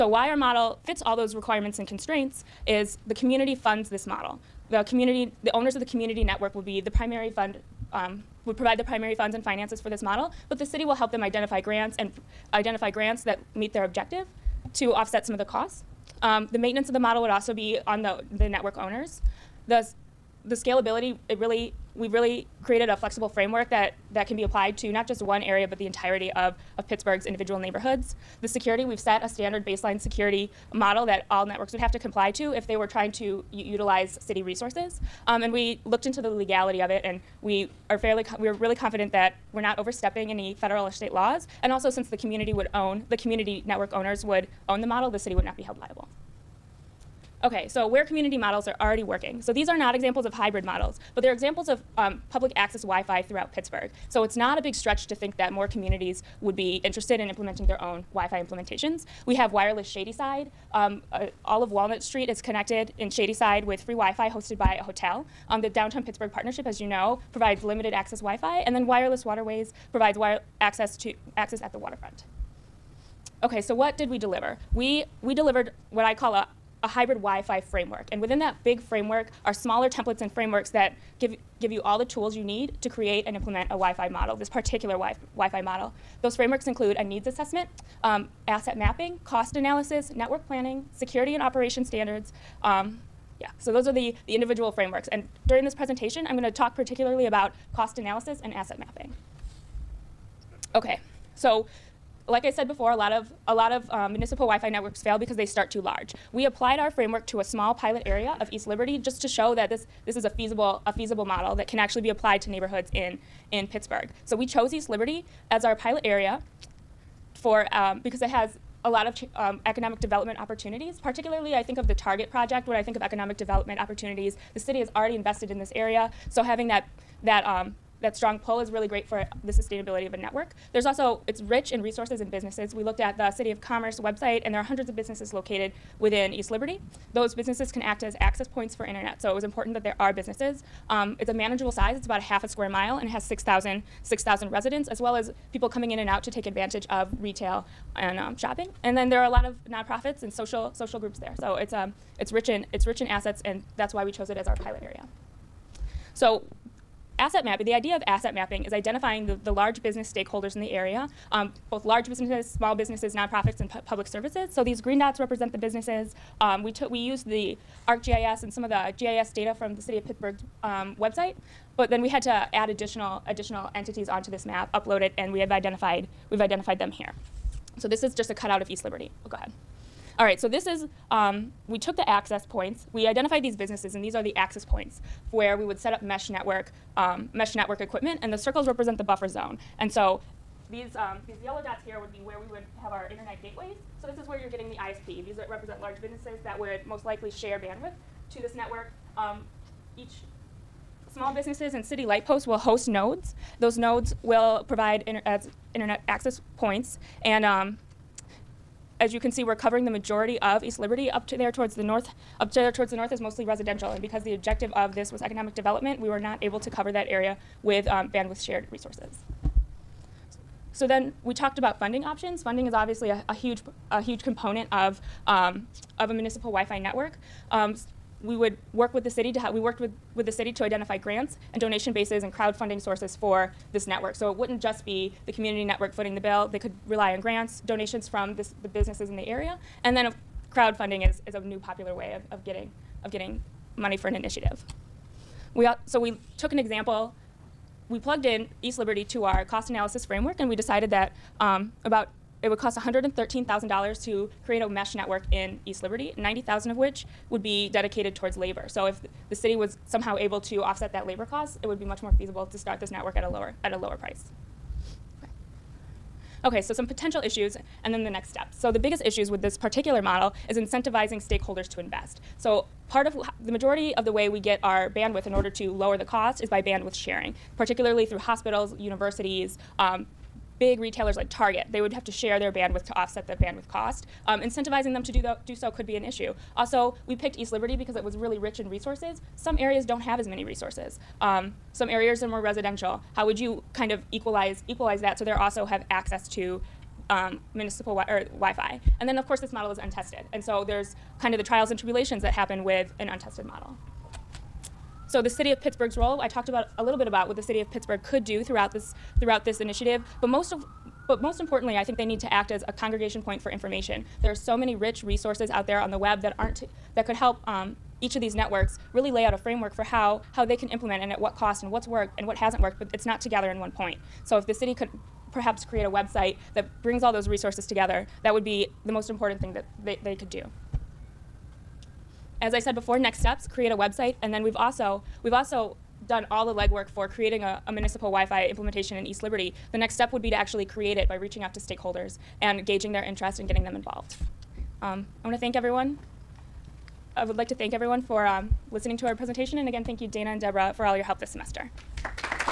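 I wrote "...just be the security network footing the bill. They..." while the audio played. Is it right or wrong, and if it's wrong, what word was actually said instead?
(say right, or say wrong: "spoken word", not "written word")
wrong: "community", not "security".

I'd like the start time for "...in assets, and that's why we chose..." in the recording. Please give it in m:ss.
2:32.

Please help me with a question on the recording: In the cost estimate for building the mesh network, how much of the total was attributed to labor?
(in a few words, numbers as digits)
$90,000.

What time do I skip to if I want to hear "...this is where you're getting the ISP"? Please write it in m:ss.
3:14.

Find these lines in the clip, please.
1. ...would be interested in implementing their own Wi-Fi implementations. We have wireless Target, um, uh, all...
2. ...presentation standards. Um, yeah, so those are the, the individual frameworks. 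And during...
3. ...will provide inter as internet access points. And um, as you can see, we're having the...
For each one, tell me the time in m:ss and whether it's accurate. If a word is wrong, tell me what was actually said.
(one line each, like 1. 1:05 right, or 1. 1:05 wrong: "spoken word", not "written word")
1. 0:56 wrong: "Shadyside", not "Target"
2. 1:31 wrong: "operation", not "presentation"
3. 3:24 wrong: "covering", not "having".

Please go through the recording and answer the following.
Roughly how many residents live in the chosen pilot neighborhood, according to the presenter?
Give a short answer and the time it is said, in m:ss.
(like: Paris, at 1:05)
6,000, at 2:23.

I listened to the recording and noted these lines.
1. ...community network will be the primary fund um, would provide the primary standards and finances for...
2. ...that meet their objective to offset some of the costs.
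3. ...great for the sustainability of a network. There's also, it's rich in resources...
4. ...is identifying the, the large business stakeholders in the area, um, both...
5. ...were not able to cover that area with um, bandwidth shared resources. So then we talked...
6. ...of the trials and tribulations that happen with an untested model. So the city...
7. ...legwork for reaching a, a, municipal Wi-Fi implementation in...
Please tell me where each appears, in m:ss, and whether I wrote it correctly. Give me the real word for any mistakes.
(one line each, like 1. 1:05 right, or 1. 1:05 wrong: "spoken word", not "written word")
1. 0:05 wrong: "funds", not "standards"
2. 0:13 right
3. 2:08 right
4. 2:38 right
5. 3:36 right
6. 5:01 right
7. 5:36 wrong: "creating", not "reaching".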